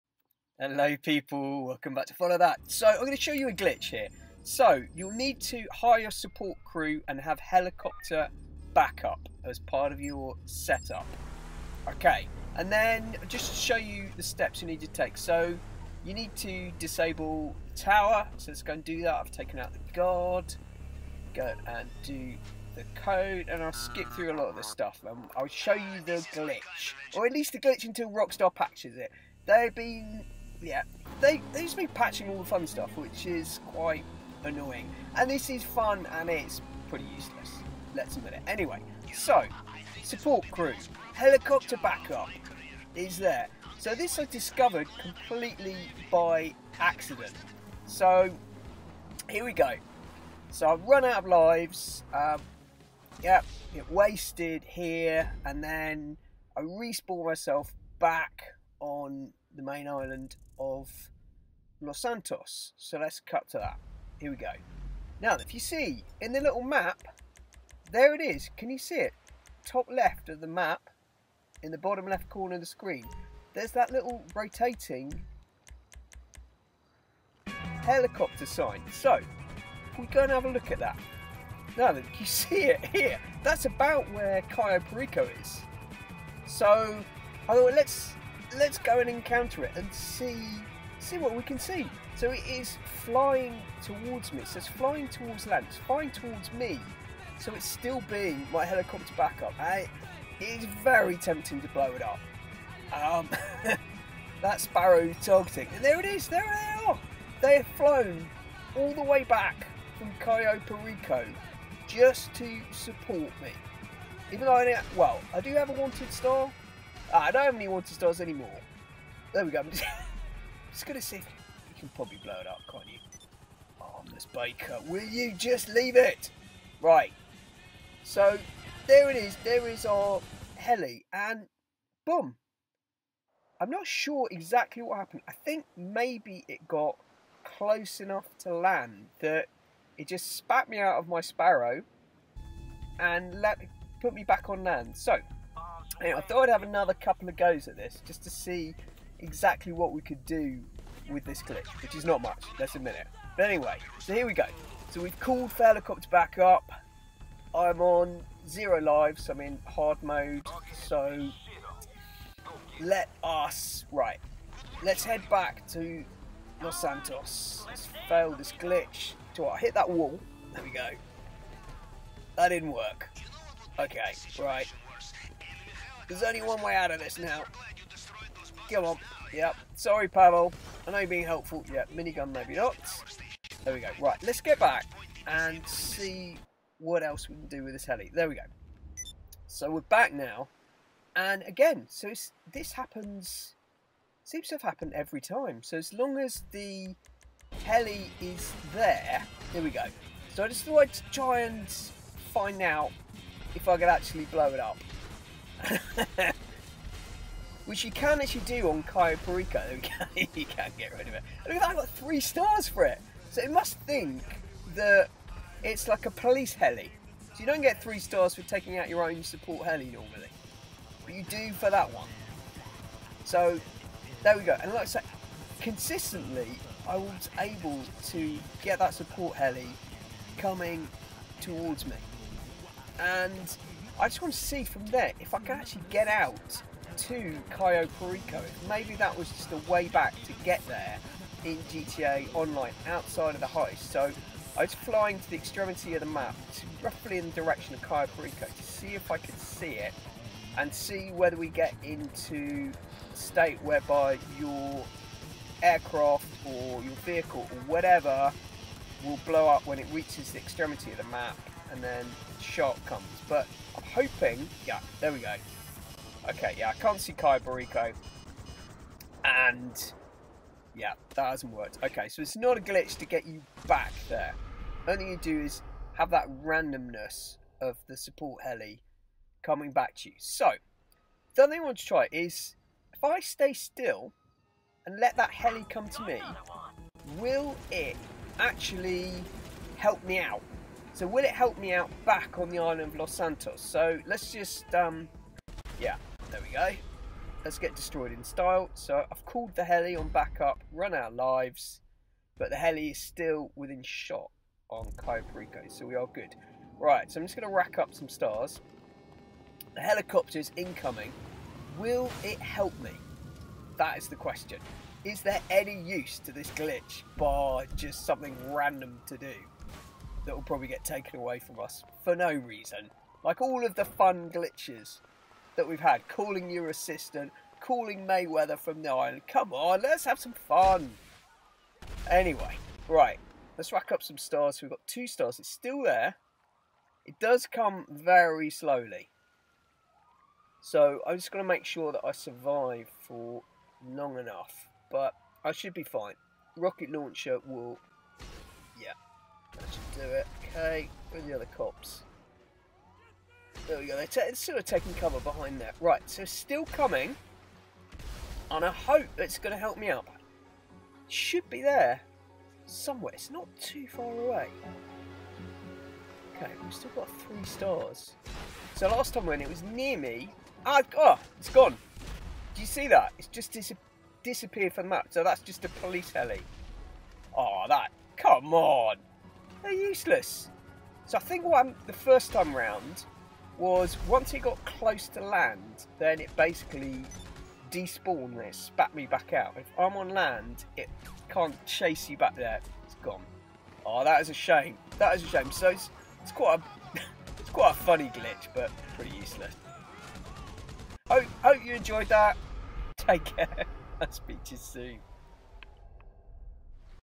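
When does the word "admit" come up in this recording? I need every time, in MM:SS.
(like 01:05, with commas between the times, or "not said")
00:38, 02:32.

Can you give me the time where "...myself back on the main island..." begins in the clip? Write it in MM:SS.
00:57.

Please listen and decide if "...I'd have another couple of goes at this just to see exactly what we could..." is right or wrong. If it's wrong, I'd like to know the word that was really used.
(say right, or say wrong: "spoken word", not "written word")
right.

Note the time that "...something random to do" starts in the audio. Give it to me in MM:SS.
05:18.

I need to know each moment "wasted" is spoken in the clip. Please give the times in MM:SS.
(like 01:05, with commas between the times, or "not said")
00:53.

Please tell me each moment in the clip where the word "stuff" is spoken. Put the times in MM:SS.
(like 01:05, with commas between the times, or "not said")
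00:24, 00:32.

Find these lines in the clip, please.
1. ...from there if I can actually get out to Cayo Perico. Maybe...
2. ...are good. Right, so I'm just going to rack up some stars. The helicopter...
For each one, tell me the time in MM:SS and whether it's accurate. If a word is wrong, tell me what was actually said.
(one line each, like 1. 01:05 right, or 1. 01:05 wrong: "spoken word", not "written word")
1. 03:54 right
2. 05:05 right.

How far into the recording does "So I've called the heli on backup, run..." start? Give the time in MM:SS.
04:58.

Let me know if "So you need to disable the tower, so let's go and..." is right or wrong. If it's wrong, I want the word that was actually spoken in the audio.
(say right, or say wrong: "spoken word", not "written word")
right.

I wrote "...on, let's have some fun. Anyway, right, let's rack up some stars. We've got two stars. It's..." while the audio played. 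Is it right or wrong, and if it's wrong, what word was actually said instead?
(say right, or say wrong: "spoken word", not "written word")
right.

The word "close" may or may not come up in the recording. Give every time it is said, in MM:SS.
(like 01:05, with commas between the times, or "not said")
02:17, 06:24.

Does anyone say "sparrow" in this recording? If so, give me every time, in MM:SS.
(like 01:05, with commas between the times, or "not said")
01:44, 02:21.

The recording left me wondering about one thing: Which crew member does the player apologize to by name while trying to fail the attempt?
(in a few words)
Pavel.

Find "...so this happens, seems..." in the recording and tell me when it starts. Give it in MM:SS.
03:11.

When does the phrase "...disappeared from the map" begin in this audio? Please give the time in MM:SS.
06:14.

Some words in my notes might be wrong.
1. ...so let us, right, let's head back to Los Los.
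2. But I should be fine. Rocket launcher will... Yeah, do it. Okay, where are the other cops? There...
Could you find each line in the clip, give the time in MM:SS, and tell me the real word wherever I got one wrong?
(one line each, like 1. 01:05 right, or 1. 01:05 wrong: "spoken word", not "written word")
1. 02:40 wrong: "Santos", not "Los"
2. 05:44 right.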